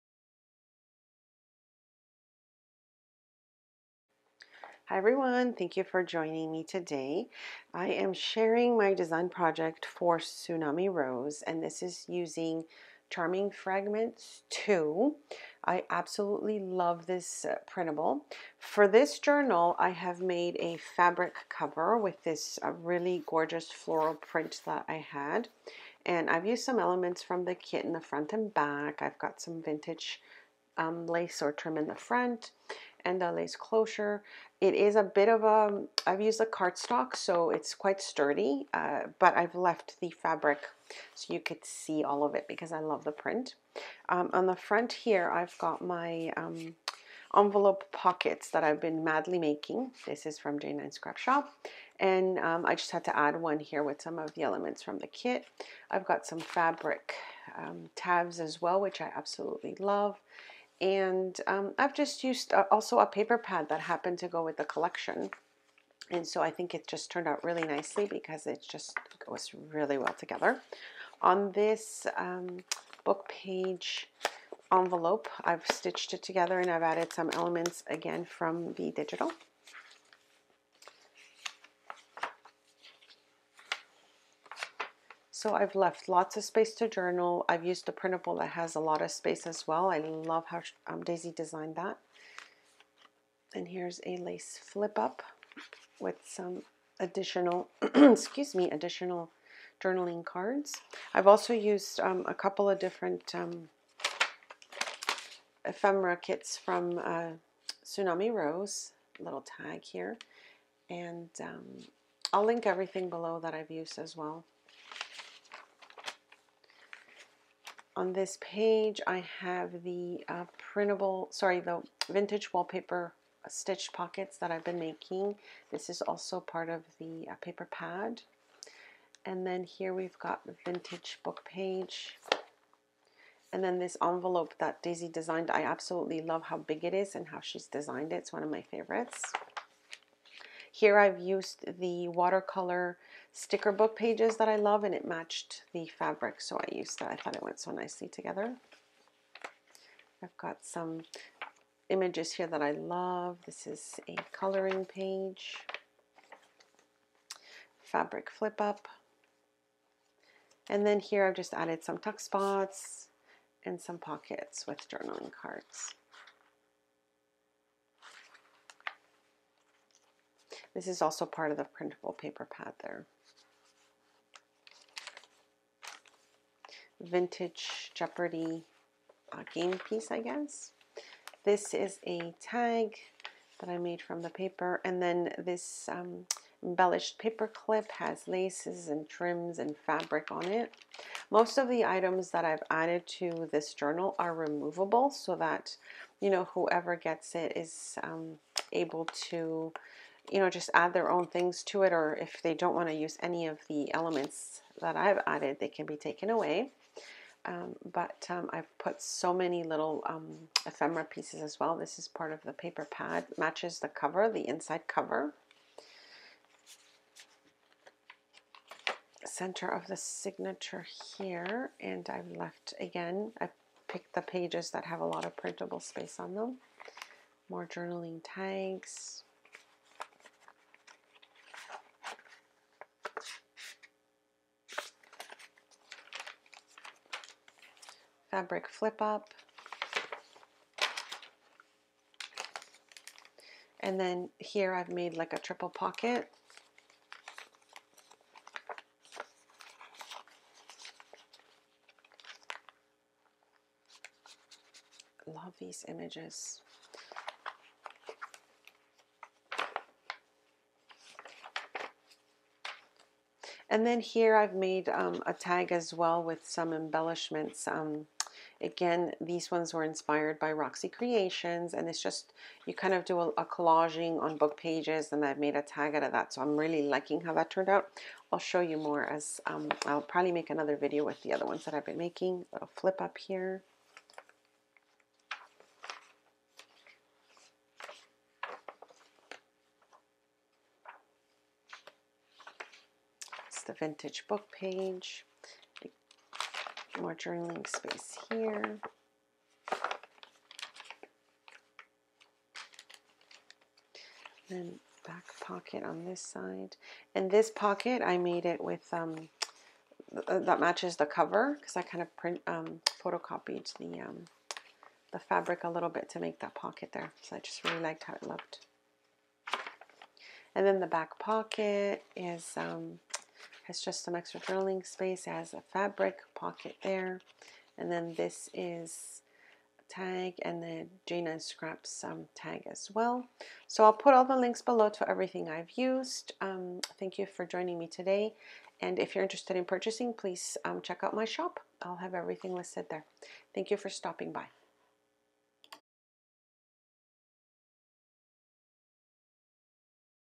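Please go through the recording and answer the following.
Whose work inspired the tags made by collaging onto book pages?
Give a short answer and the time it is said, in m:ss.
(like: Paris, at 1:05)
Roxy Creations, at 4:30.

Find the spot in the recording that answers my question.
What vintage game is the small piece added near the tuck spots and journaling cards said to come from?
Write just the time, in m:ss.
2:57.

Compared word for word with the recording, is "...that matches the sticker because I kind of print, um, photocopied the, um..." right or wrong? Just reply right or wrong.
wrong.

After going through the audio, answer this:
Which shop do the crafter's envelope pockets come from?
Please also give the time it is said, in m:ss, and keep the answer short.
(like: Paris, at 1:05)
J9 Scrap Shop, at 0:50.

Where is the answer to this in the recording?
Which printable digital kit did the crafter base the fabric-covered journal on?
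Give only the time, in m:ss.
0:13.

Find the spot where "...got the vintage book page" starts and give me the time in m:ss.
2:10.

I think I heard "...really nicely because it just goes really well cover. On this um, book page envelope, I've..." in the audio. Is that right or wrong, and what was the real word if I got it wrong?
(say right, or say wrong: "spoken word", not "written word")
wrong: "together", not "cover".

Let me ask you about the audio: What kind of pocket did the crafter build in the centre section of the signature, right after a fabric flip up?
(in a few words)
triple pocket.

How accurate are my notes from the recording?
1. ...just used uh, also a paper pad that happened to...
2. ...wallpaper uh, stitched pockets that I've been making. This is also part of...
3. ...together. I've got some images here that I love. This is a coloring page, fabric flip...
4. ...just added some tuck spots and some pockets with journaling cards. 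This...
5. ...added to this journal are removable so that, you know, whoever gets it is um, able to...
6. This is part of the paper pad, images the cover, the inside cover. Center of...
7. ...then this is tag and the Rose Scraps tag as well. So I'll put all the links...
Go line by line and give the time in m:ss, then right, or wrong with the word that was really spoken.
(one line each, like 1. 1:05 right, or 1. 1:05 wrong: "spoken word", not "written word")
1. 1:01 right
2. 2:02 right
3. 2:28 right
4. 2:41 right
5. 3:12 right
6. 3:31 wrong: "matches", not "images"
7. 5:27 wrong: "Gina", not "Rose".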